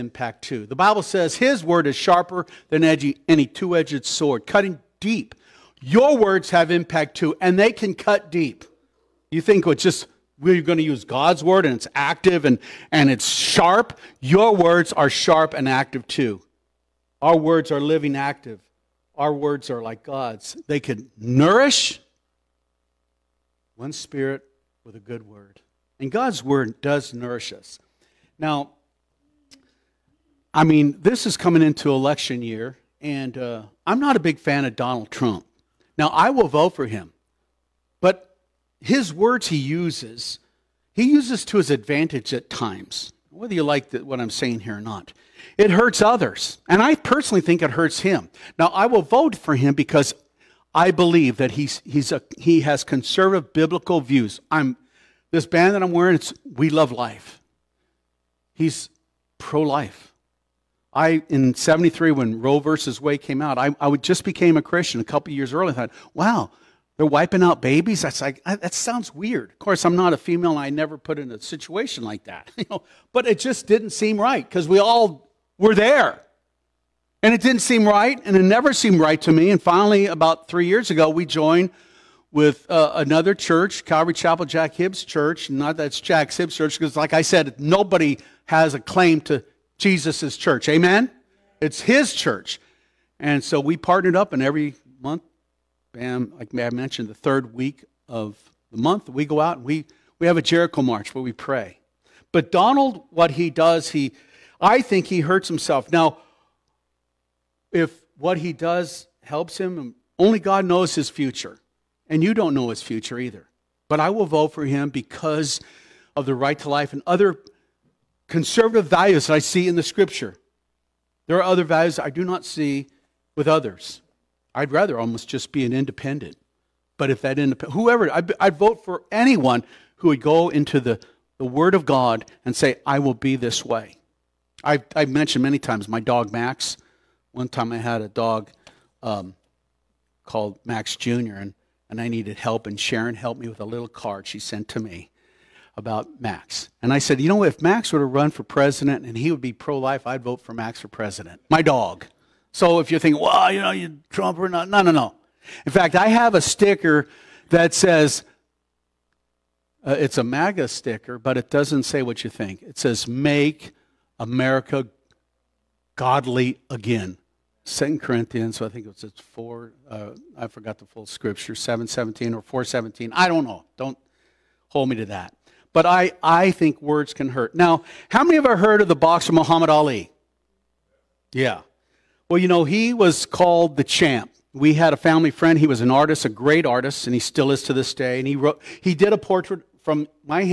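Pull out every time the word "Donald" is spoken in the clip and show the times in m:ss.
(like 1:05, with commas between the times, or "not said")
0:34, 1:42.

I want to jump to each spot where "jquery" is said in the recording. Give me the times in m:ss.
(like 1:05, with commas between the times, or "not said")
not said.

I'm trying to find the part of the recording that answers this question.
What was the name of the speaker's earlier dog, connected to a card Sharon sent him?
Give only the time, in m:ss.
2:20.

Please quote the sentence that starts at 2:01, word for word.
There are other values I do not see with others.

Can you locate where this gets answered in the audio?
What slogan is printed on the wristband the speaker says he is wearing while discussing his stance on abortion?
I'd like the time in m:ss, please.
0:56.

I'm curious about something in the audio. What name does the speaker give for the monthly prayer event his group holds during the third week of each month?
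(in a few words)
Jericho march.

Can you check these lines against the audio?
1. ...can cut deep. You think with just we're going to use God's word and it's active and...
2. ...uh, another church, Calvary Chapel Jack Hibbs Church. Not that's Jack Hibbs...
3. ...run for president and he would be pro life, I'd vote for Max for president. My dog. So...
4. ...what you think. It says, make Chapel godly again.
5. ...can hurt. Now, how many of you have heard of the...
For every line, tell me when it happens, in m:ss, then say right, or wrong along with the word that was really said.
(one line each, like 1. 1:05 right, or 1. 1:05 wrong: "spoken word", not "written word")
1. 0:07 right
2. 1:22 right
3. 2:28 right
4. 2:42 wrong: "America", not "Chapel"
5. 2:57 right.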